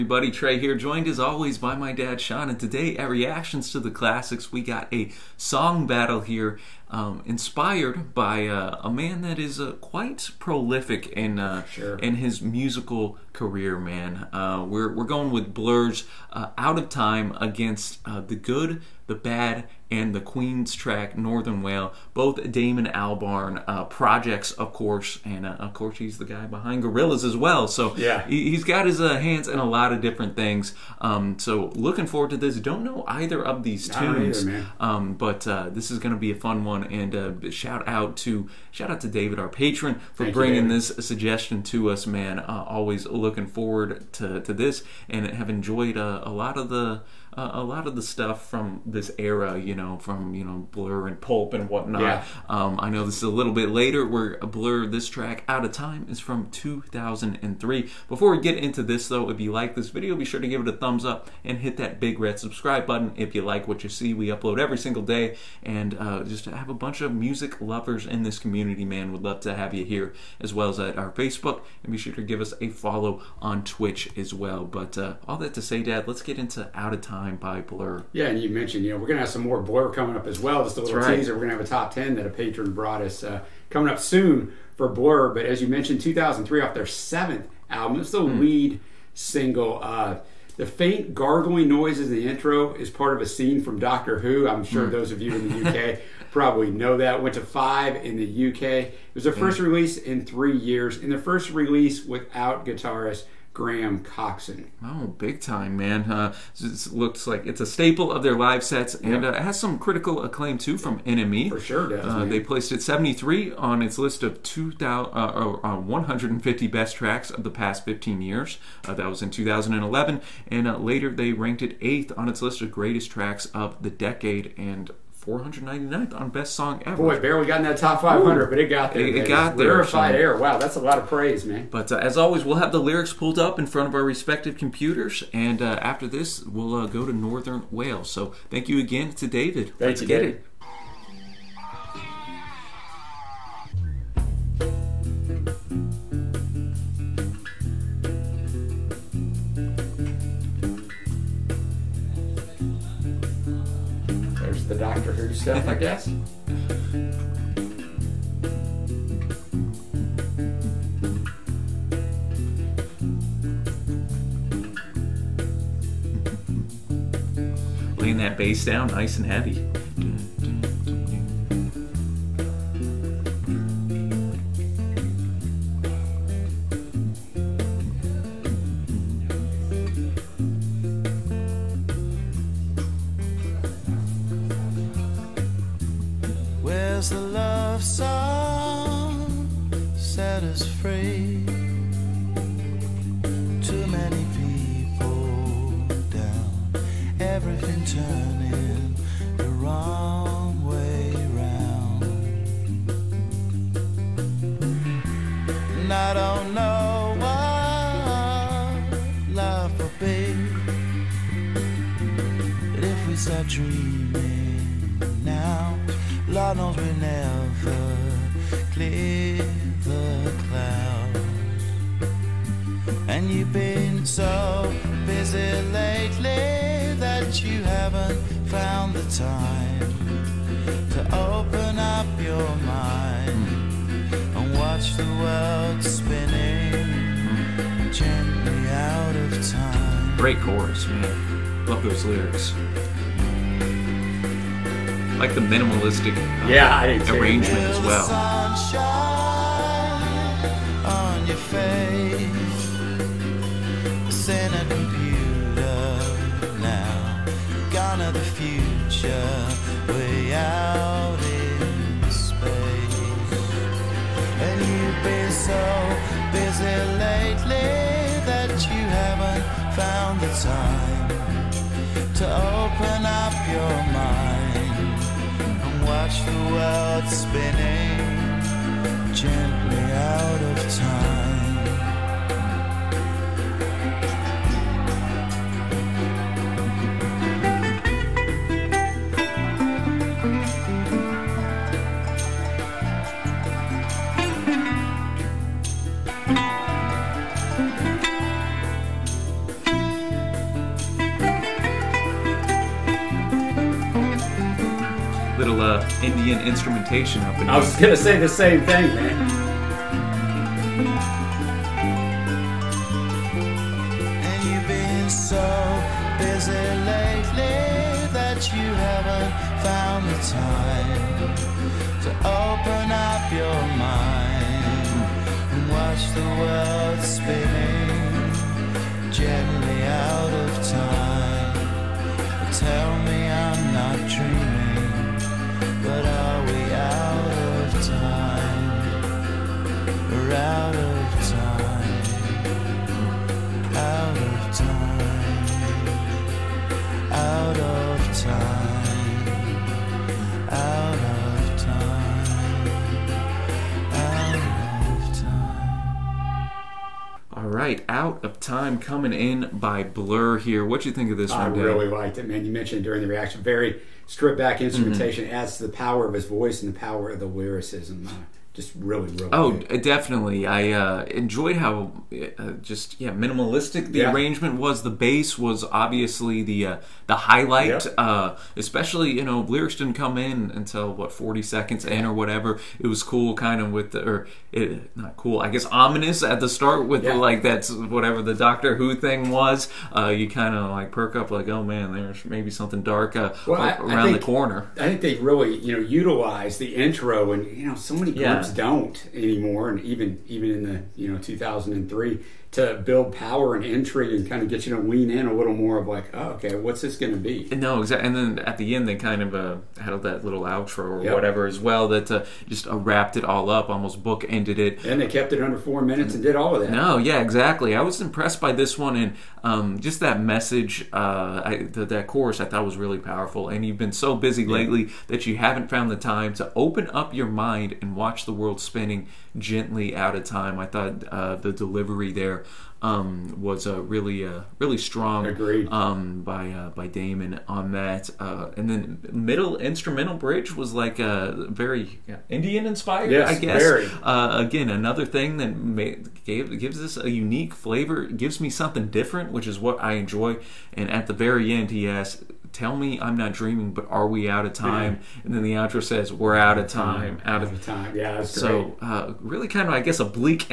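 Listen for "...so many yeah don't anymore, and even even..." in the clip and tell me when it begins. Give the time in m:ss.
6:37.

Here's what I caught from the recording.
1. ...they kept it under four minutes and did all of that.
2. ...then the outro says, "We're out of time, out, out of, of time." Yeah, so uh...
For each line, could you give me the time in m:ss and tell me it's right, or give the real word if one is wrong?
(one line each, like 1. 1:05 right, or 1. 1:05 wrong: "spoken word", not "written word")
1. 6:55 right
2. 7:35 right.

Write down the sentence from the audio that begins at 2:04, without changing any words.
And 499th on Best Song Ever.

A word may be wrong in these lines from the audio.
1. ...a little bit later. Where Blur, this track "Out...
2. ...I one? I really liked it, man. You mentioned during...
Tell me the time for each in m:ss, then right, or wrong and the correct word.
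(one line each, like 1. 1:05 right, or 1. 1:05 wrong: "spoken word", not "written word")
1. 0:53 right
2. 6:01 right.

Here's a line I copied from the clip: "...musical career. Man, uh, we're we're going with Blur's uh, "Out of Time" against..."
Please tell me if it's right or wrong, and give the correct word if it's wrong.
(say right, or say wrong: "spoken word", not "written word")
right.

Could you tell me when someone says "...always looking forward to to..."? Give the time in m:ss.
0:42.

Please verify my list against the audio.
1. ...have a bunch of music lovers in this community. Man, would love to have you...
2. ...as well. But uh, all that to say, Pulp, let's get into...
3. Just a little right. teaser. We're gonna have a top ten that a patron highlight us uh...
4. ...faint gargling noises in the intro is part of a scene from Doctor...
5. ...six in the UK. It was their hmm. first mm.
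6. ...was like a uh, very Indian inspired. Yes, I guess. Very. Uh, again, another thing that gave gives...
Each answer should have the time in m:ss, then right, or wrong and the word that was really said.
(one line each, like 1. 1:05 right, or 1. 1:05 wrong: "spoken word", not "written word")
1. 1:06 right
2. 1:14 wrong: "Dad", not "Pulp"
3. 1:20 wrong: "brought", not "highlight"
4. 1:30 right
5. 1:37 wrong: "five", not "six"
6. 7:20 right.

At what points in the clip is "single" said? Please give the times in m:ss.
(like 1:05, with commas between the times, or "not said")
1:04, 1:29.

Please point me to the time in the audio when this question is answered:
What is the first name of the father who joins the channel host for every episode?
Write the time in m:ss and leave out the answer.
0:02.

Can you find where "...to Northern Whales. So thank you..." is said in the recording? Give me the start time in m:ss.
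2:17.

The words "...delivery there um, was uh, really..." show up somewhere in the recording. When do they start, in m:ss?
7:11.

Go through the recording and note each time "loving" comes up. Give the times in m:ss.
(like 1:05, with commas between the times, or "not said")
not said.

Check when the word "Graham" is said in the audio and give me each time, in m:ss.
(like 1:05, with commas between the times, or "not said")
1:43.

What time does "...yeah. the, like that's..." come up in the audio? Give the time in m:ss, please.
6:27.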